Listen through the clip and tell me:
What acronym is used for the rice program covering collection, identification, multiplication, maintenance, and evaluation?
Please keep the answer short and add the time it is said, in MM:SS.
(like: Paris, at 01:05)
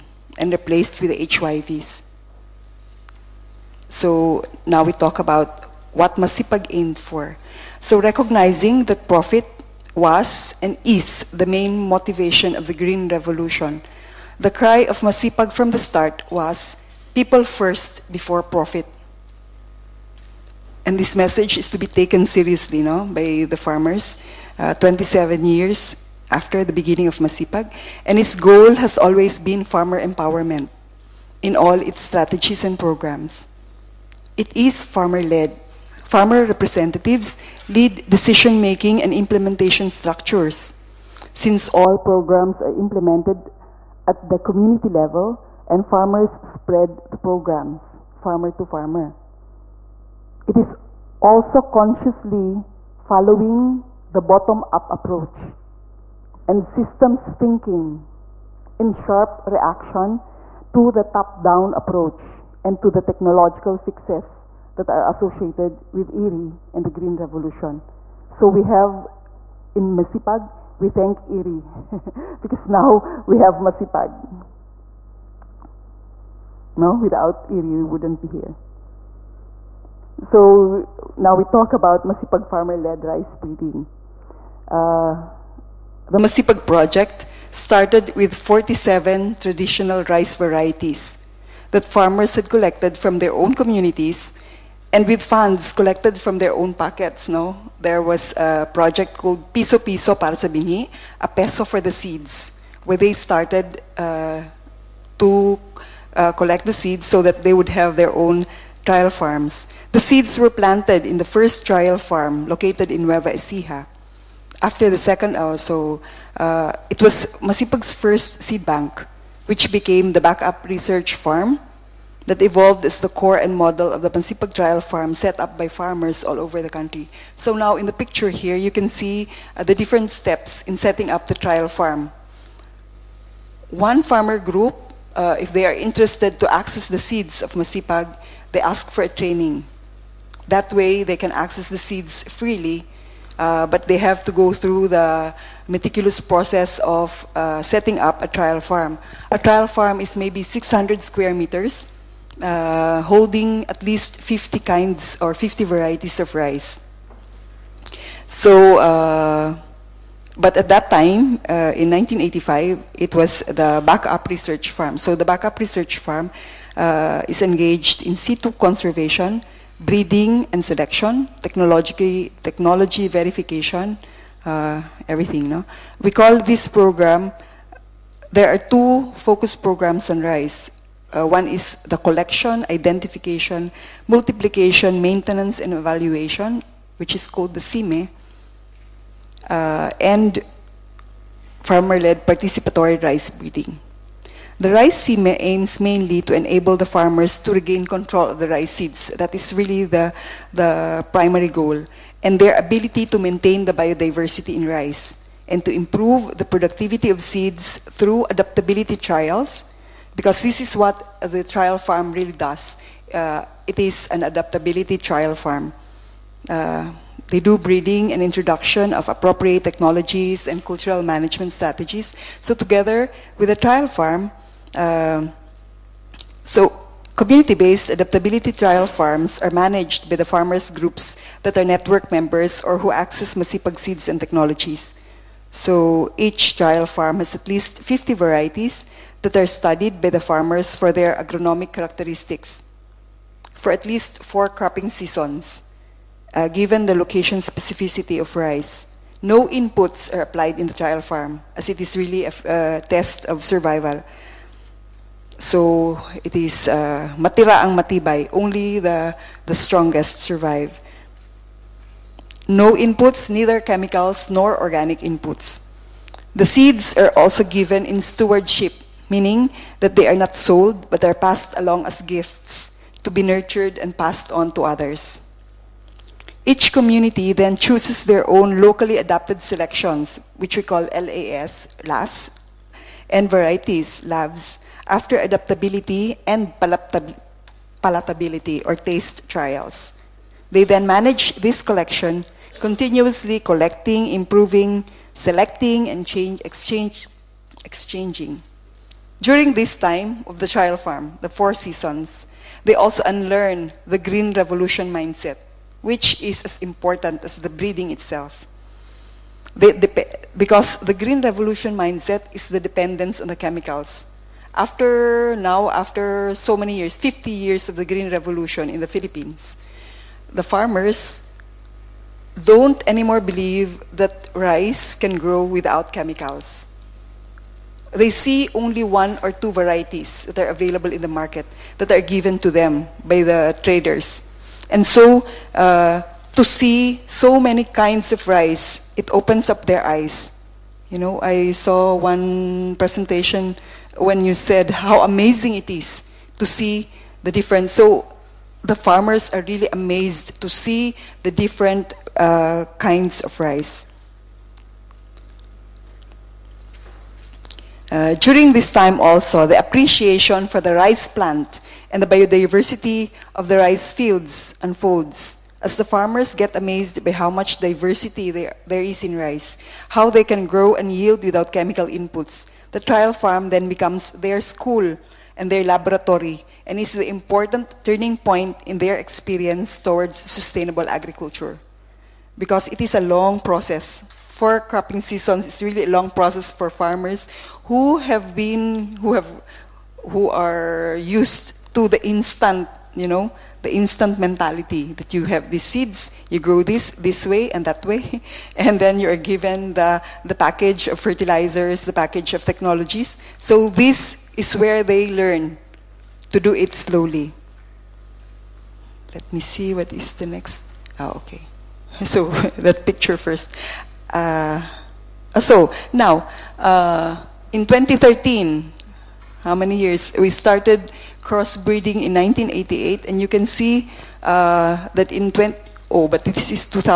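CIME, at 03:07.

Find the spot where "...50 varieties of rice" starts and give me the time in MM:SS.
02:35.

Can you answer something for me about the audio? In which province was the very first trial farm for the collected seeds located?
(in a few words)
Nueva Ecija.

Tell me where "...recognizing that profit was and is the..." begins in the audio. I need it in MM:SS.
00:08.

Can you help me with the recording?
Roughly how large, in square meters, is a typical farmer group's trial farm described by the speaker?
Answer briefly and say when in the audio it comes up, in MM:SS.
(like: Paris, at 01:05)
600 square meters, at 02:30.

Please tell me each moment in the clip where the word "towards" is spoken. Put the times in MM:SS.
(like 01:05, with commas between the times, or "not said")
06:19.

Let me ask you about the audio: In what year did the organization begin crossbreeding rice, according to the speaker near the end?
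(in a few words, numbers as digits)
1988.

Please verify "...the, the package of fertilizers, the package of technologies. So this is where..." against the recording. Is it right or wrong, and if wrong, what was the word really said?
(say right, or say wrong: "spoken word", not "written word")
right.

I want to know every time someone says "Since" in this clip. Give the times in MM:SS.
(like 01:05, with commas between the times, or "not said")
00:41.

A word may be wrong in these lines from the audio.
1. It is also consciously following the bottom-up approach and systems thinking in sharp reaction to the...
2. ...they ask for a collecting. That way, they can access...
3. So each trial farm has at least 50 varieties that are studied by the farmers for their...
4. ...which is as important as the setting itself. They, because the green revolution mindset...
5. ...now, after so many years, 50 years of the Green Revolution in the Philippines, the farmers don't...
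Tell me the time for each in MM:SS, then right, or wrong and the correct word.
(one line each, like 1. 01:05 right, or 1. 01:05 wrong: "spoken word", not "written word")
1. 00:50 right
2. 02:18 wrong: "training", not "collecting"
3. 03:55 right
4. 05:05 wrong: "breeding", not "setting"
5. 05:15 right.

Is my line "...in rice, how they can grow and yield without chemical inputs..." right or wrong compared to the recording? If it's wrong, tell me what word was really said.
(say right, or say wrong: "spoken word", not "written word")
right.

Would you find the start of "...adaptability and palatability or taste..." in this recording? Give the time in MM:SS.
04:45.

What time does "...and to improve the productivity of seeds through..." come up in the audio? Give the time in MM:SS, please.
03:25.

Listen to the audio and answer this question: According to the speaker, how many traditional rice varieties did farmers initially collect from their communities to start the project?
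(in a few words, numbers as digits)
47.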